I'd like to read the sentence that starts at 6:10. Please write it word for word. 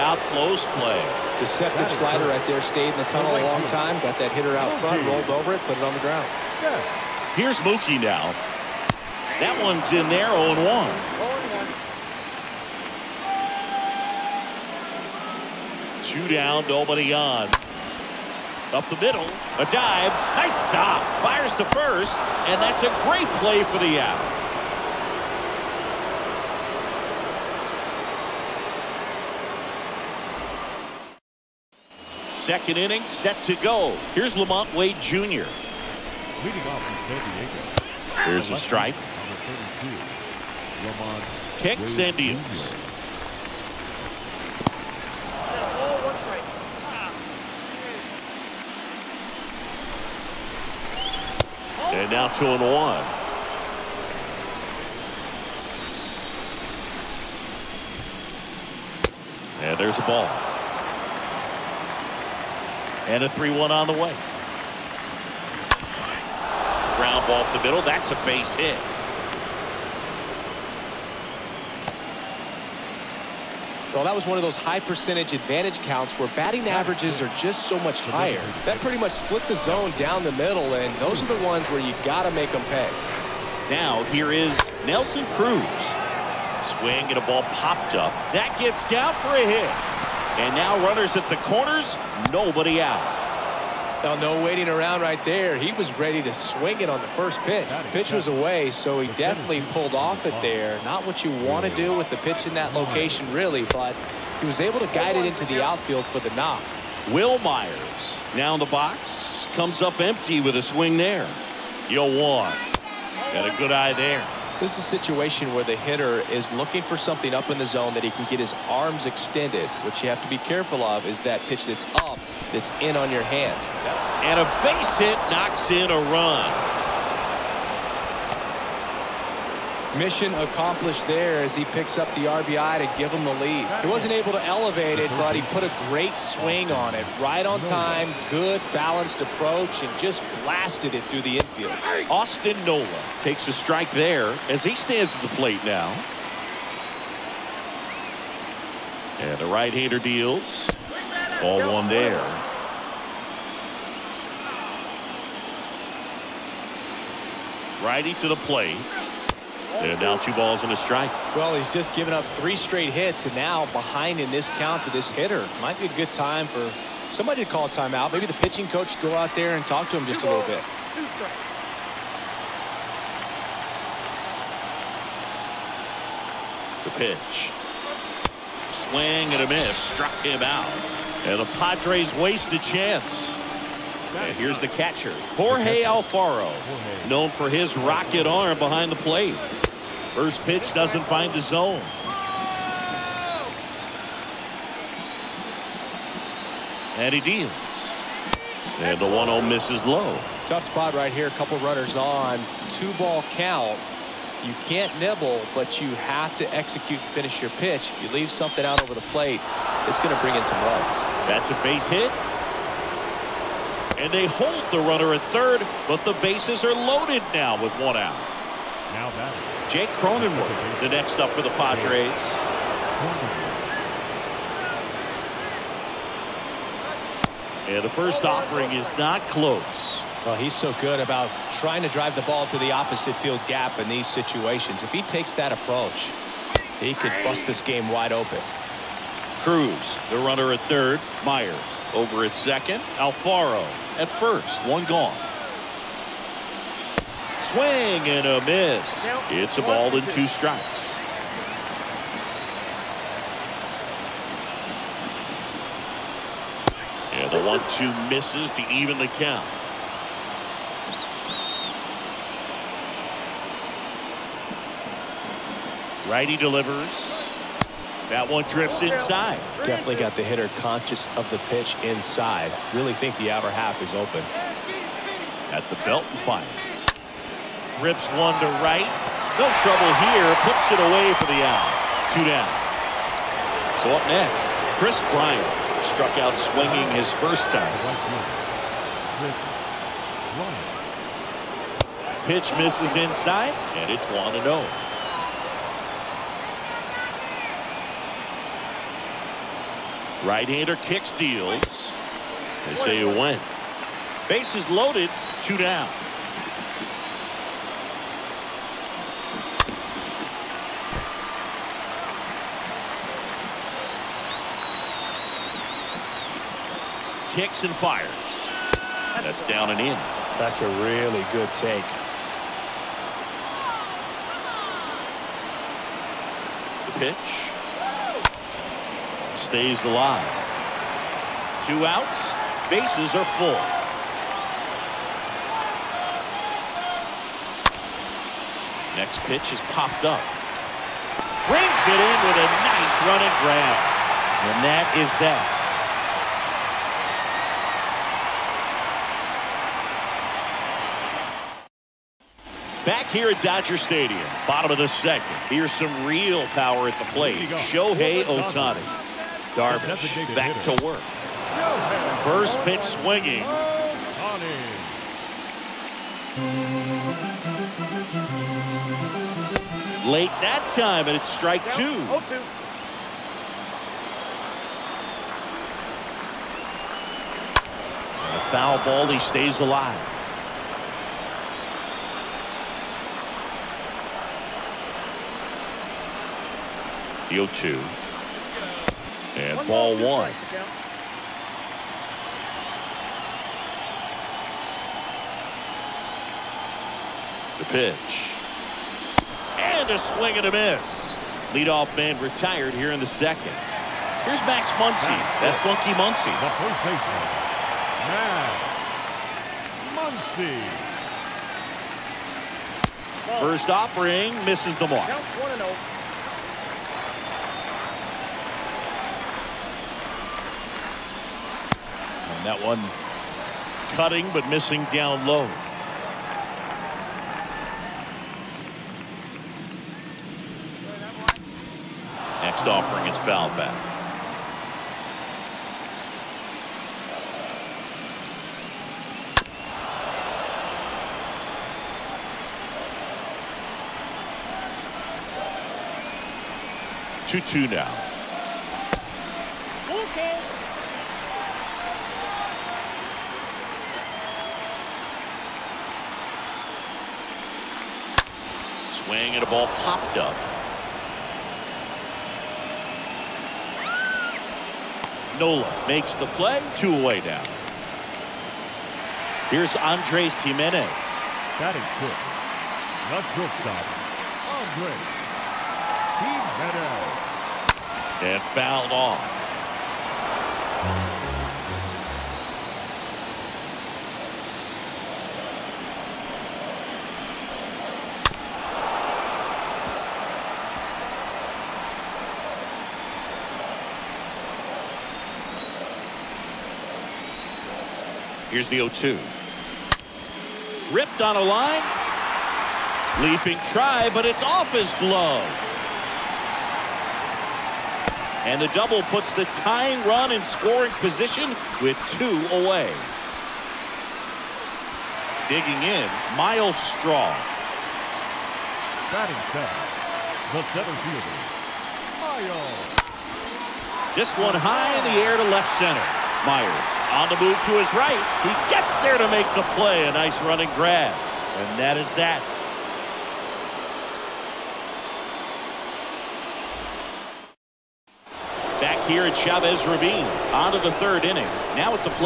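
Late that time, and it's strike oh, two.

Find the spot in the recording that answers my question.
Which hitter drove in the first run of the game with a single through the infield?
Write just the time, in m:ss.
1:47.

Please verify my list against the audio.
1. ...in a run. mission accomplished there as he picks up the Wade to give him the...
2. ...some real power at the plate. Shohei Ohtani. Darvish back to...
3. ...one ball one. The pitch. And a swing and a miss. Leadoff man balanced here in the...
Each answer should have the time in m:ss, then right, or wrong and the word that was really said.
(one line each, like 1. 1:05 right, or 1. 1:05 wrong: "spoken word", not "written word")
1. 2:05 wrong: "RBI", not "Wade"
2. 5:55 right
3. 6:29 wrong: "retired", not "balanced".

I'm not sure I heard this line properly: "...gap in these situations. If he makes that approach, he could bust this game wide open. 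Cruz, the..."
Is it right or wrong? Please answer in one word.
wrong.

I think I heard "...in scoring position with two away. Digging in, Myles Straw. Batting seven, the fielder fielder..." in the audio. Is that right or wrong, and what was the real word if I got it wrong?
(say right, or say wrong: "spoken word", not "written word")
wrong: "center", not "fielder".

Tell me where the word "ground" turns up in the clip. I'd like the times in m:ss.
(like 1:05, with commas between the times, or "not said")
0:06, 1:06.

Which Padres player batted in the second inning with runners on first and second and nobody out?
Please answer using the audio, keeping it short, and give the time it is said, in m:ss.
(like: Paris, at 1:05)
Nelson Cruz, at 1:24.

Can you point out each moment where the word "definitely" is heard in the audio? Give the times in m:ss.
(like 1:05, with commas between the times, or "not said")
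1:39, 4:29.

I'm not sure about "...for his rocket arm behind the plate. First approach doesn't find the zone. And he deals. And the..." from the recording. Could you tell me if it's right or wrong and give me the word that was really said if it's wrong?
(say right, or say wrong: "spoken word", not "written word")
wrong: "pitch", not "approach".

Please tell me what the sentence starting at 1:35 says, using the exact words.
He was ready to swing it on the first pitch.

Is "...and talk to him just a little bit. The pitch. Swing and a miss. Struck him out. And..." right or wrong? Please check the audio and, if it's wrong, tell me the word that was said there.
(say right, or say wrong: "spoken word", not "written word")
right.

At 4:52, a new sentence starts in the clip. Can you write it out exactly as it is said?
Pitch misses inside, and it's 1 0.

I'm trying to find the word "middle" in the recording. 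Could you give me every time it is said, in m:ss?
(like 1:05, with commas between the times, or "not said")
0:19, 1:07, 1:20.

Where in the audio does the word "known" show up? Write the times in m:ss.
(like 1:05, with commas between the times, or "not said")
3:07.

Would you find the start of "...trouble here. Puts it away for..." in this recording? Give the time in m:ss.
4:39.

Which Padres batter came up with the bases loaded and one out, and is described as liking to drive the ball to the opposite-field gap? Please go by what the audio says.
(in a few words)
Jake Cronenworth.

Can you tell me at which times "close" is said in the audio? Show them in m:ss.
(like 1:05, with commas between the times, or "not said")
0:00, 3:49.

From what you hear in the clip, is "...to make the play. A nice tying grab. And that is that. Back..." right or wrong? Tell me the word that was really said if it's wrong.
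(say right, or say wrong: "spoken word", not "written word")
wrong: "running", not "tying".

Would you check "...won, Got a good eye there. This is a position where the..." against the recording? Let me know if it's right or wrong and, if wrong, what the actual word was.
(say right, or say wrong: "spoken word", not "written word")
wrong: "situation", not "position".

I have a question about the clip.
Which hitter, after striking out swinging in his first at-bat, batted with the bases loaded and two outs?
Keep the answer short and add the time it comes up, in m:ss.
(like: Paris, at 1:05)
Kris Bryant, at 4:44.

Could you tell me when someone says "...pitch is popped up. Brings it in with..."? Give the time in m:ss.
5:39.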